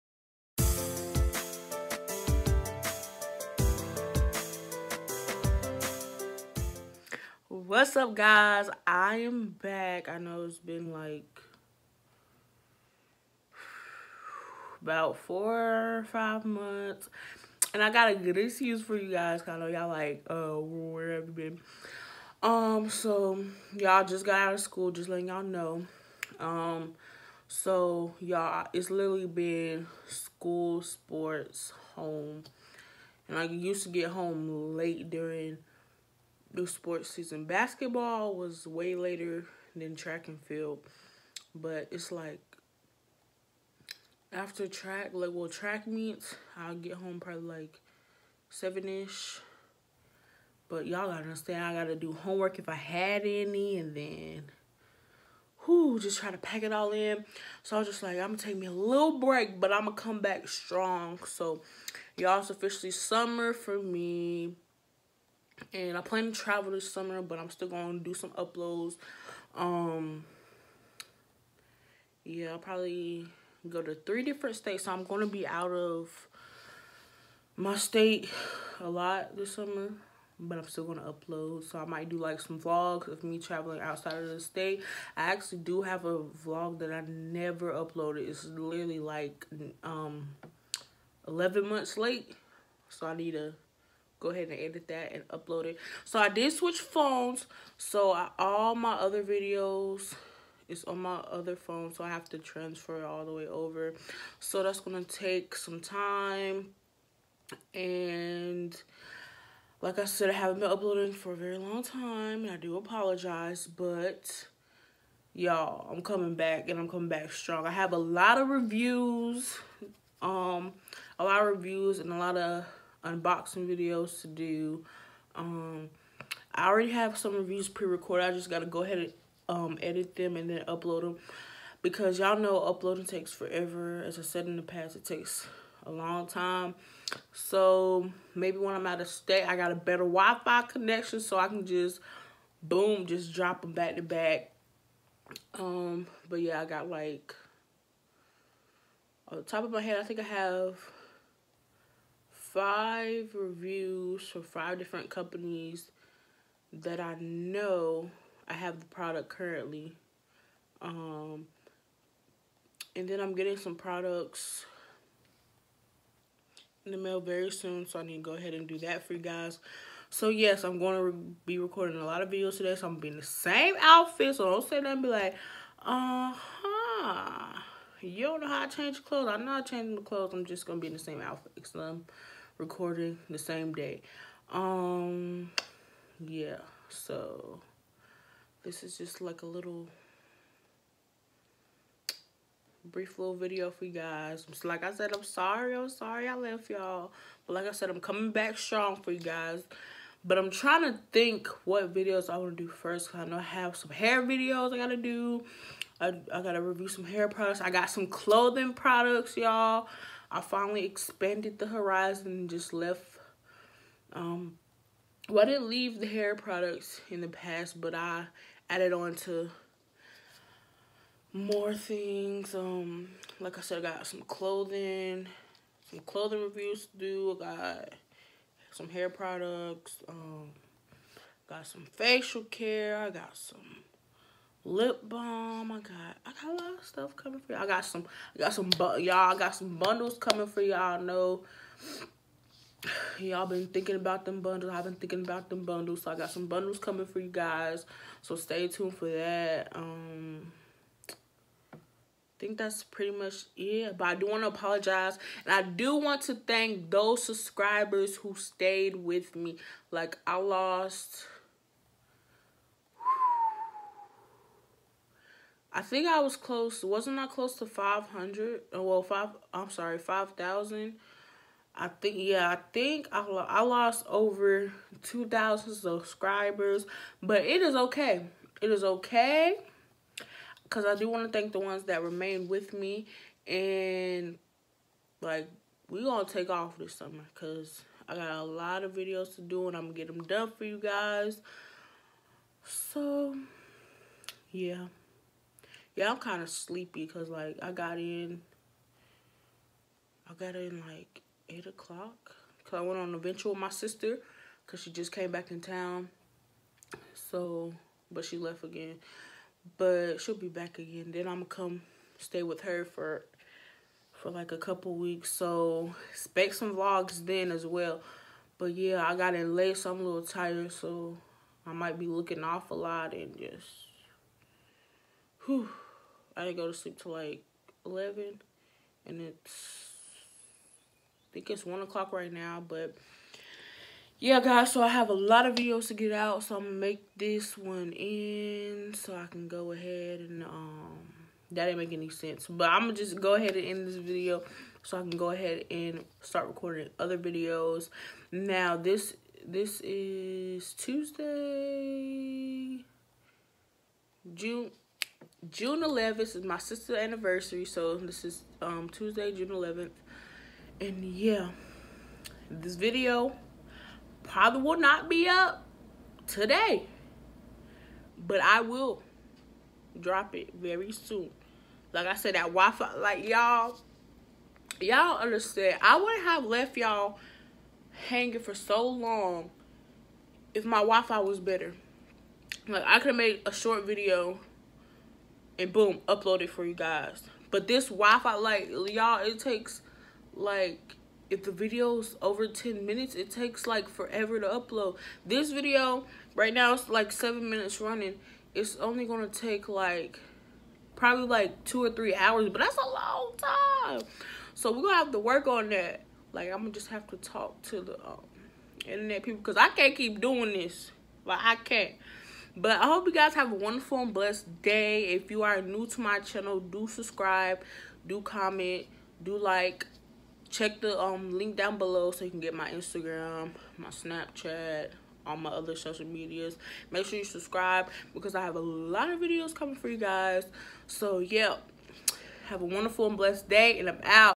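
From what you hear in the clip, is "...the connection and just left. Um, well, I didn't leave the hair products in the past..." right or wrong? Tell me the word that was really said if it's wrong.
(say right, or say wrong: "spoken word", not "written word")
wrong: "horizon", not "connection".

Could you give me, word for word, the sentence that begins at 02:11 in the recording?
Because y'all know uploading takes forever.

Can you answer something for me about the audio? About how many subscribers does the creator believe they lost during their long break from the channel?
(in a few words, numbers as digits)
2,000.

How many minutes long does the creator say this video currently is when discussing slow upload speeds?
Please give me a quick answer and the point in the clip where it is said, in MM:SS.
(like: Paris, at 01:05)
7, at 06:37.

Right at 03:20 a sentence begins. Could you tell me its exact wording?
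But I'm trying to think what videos I want to do first.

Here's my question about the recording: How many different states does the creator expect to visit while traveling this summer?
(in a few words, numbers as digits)
3.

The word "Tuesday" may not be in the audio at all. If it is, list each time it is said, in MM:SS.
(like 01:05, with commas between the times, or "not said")
05:50, 05:58.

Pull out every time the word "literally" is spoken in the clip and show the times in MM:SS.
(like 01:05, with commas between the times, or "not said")
00:28, 01:28.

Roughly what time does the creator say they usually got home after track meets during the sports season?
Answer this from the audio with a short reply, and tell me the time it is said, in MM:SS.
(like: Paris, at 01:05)
7, at 00:48.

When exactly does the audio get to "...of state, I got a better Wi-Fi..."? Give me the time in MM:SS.
02:19.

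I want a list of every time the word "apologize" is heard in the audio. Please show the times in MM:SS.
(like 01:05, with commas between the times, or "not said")
01:52, 04:14.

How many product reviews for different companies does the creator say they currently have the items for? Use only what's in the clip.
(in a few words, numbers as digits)
5.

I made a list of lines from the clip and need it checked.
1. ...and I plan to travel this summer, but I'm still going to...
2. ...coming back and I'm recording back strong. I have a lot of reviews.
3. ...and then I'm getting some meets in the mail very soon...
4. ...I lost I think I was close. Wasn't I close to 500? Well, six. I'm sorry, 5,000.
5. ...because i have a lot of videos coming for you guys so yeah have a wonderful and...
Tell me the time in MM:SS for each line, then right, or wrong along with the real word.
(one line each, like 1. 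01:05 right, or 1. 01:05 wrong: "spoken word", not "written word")
1. 01:05 right
2. 01:56 wrong: "coming", not "recording"
3. 02:42 wrong: "products", not "meets"
4. 04:20 wrong: "five", not "six"
5. 07:08 right.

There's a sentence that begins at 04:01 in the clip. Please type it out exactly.
Know y'all been thinking about them bundles.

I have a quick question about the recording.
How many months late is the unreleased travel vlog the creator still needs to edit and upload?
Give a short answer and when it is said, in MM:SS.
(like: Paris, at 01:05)
11, at 01:31.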